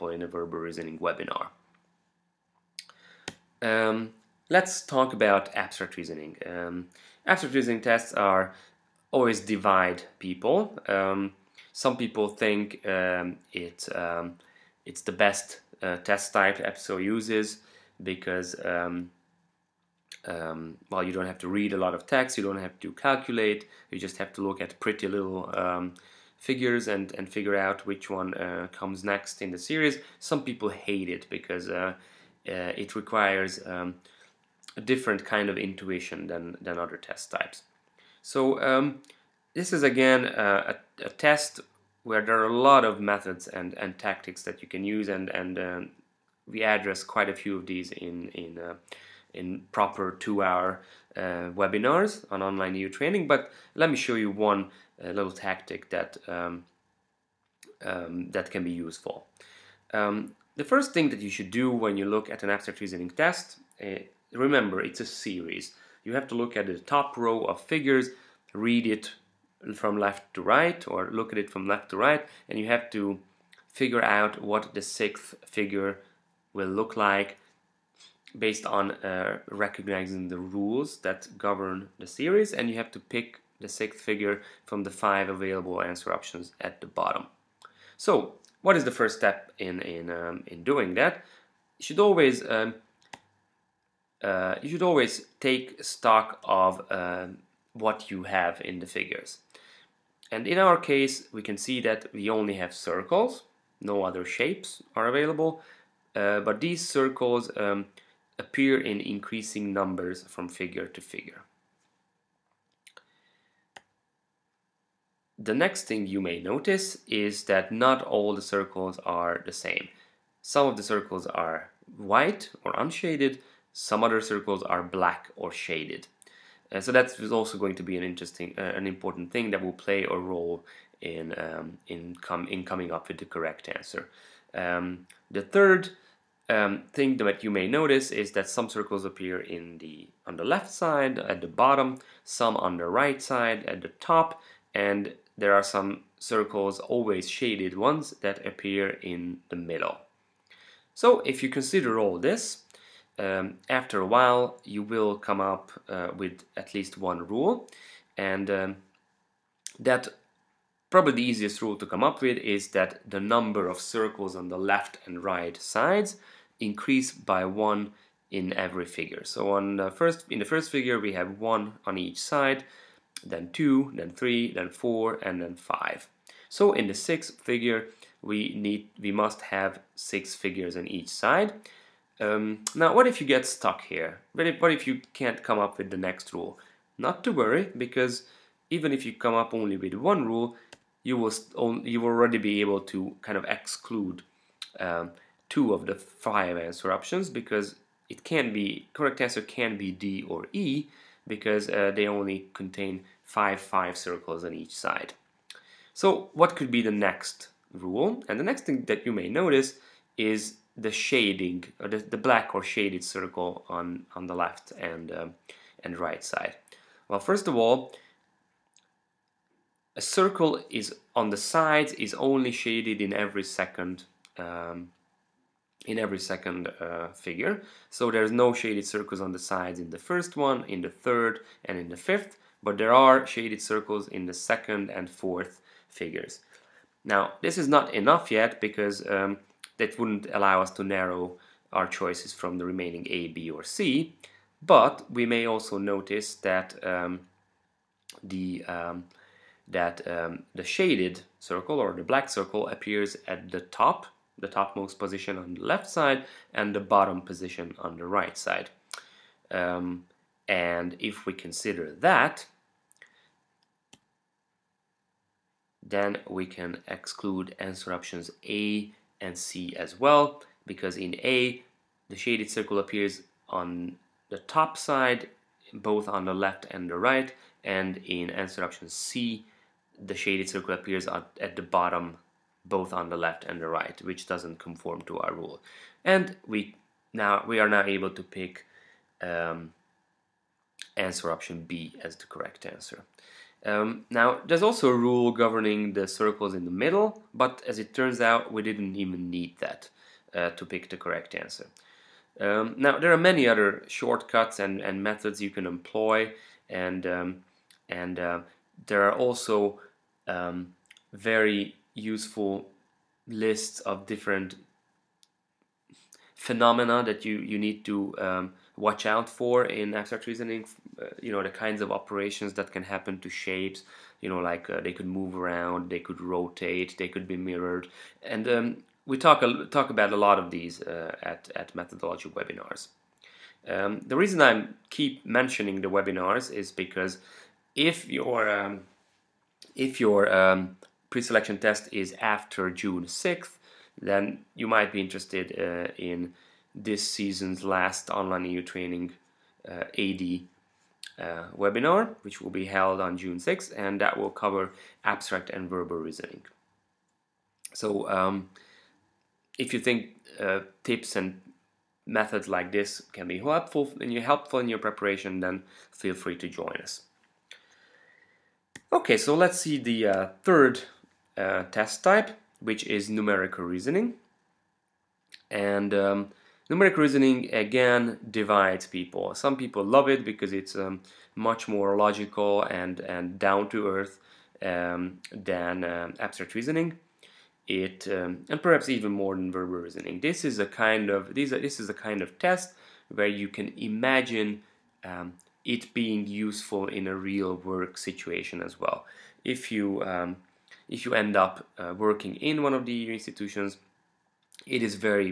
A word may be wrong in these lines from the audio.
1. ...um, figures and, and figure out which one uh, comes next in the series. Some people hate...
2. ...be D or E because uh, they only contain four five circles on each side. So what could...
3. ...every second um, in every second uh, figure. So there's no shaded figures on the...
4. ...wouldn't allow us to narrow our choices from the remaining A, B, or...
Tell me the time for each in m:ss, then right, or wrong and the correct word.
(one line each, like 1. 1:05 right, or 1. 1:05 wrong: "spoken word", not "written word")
1. 0:25 right
2. 3:19 wrong: "five", not "four"
3. 3:43 wrong: "circles", not "figures"
4. 3:59 right.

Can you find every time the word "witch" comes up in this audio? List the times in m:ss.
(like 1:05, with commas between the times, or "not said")
not said.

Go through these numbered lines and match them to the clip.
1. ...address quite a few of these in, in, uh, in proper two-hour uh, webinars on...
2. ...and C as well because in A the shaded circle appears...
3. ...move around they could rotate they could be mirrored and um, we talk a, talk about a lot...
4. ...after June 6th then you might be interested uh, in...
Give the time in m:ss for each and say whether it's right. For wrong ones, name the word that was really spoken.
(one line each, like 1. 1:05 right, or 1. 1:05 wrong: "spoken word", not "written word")
1. 0:46 right
2. 4:29 right
3. 5:25 right
4. 5:42 right.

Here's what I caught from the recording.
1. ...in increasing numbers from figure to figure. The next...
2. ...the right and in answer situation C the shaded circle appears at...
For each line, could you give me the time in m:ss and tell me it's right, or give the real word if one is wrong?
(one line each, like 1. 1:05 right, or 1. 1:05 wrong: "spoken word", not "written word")
1. 1:48 right
2. 4:36 wrong: "option", not "situation".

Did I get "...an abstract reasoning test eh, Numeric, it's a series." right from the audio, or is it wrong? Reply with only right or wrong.
wrong.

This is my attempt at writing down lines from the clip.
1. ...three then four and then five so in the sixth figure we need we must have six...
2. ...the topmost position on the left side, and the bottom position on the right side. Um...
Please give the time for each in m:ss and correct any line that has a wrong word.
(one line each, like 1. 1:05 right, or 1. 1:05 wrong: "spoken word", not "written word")
1. 2:54 right
2. 4:14 right.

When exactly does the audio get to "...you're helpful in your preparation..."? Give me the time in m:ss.
6:04.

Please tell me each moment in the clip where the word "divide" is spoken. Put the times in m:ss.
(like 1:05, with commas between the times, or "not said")
0:09, 6:18.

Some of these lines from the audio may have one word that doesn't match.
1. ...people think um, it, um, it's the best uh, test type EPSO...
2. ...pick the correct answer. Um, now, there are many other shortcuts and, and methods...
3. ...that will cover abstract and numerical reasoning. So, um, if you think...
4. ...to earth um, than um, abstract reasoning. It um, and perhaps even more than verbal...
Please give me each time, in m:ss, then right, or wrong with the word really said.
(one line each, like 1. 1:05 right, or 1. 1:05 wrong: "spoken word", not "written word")
1. 0:11 right
2. 5:00 right
3. 5:54 wrong: "verbal", not "numerical"
4. 6:23 right.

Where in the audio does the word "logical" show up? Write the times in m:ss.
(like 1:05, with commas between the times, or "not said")
6:21.